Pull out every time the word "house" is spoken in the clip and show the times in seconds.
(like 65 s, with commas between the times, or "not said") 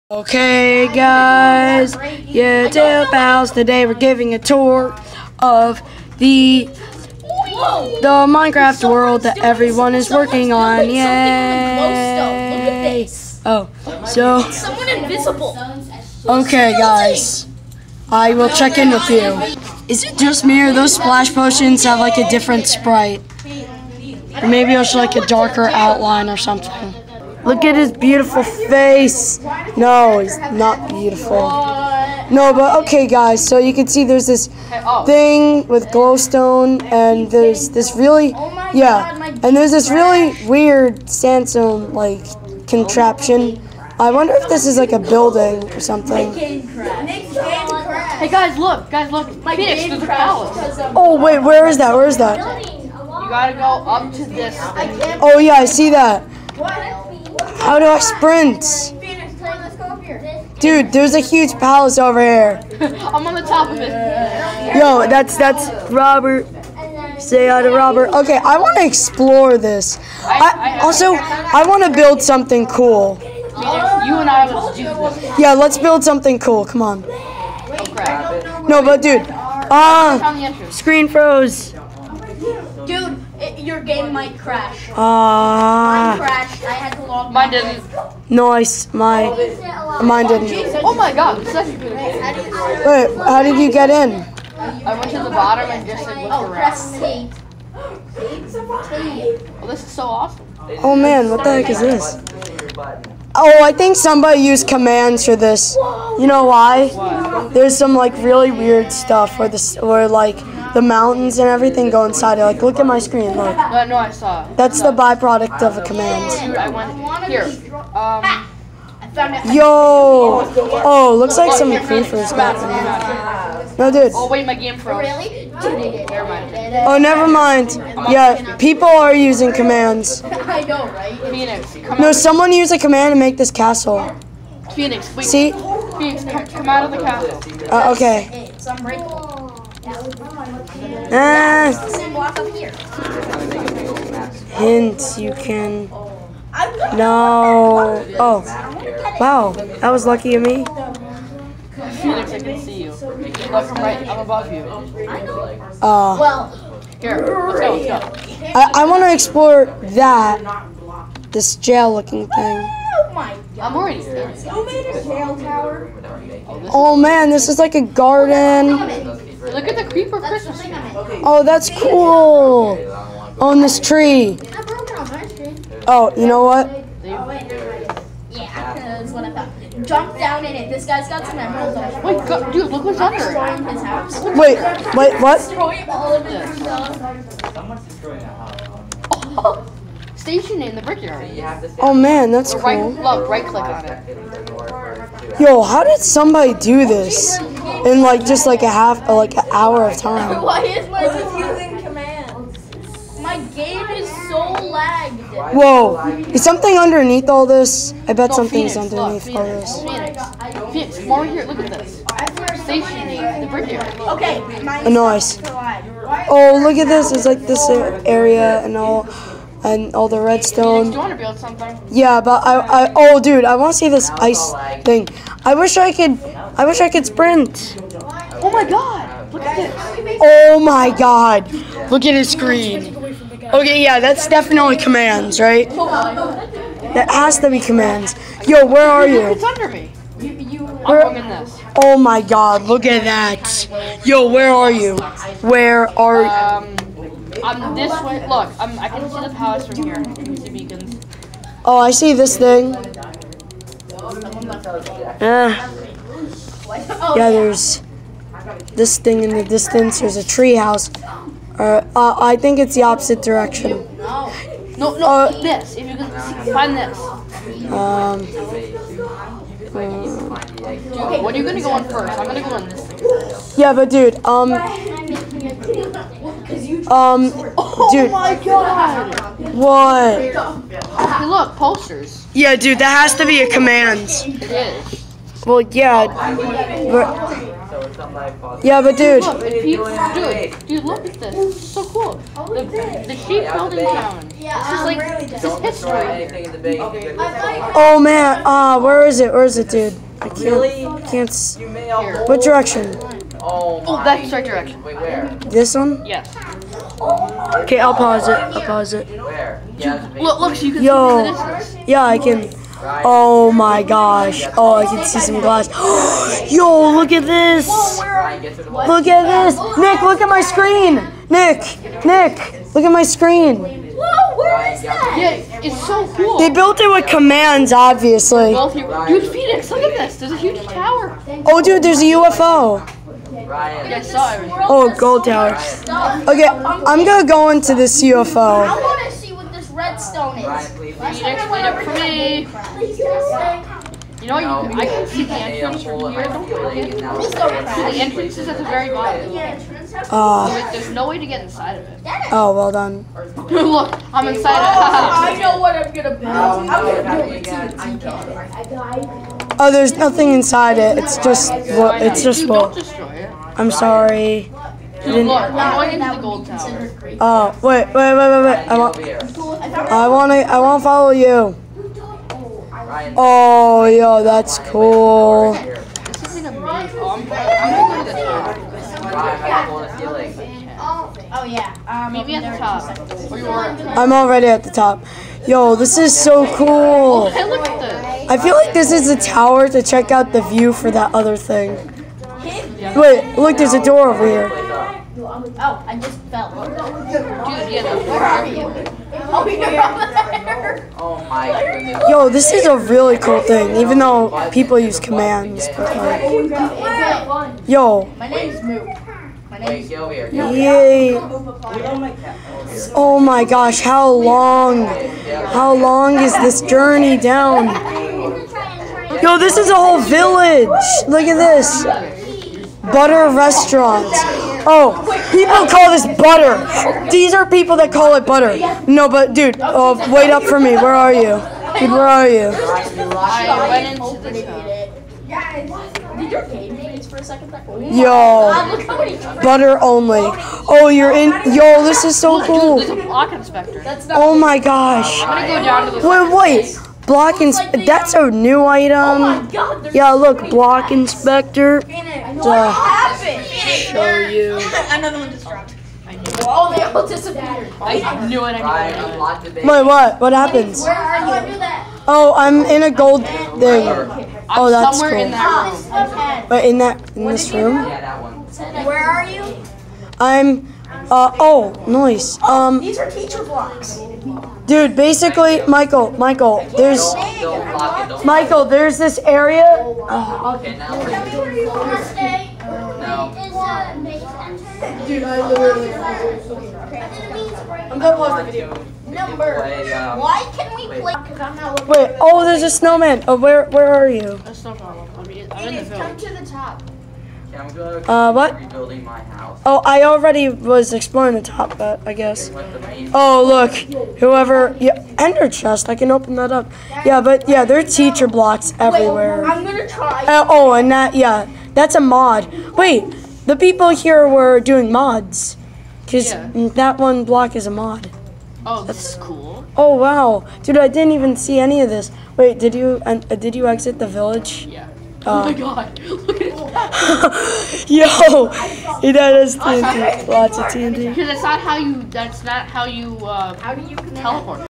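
188 s, 260 s, 499 s.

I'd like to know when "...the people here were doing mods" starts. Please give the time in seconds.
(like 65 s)
513 s.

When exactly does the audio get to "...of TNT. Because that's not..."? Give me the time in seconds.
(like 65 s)
530 s.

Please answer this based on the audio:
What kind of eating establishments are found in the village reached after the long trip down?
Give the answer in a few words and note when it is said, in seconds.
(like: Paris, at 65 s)
Butter restaurants, at 422 s.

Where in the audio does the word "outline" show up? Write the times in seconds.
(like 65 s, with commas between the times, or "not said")
25 s.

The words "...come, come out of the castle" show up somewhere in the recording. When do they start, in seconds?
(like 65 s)
136 s.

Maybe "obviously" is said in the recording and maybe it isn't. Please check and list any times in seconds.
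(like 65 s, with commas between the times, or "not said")
327 s.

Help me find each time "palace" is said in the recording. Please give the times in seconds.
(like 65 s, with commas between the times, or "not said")
50 s, 61 s, 249 s.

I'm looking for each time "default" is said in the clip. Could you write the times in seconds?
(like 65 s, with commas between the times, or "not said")
not said.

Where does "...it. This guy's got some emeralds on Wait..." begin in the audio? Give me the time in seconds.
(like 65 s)
180 s.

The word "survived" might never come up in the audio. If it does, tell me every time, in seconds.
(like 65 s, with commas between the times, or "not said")
not said.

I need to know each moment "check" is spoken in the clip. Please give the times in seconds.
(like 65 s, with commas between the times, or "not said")
18 s, 389 s.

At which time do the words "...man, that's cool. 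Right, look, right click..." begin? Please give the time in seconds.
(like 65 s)
191 s.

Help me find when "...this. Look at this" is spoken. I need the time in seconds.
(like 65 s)
317 s.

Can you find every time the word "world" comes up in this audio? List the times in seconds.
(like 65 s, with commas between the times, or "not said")
8 s.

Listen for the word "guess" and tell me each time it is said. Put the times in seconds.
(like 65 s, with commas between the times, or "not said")
502 s.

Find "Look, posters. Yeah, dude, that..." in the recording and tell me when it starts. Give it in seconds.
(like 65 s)
281 s.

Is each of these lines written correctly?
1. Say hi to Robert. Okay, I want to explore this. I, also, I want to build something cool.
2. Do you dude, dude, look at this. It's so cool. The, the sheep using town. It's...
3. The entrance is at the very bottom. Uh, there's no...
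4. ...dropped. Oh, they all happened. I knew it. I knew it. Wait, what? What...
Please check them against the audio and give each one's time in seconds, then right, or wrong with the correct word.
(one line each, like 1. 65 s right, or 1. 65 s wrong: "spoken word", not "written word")
1. 67 s right
2. 289 s wrong: "building", not "using"
3. 346 s right
4. 455 s wrong: "disappeared", not "happened".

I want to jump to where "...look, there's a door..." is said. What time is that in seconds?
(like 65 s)
393 s.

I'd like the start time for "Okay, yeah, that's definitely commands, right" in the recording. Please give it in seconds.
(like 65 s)
233 s.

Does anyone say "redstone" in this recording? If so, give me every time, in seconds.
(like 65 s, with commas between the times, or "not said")
220 s, 339 s.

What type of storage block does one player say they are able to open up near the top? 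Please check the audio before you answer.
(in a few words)
Ender chest.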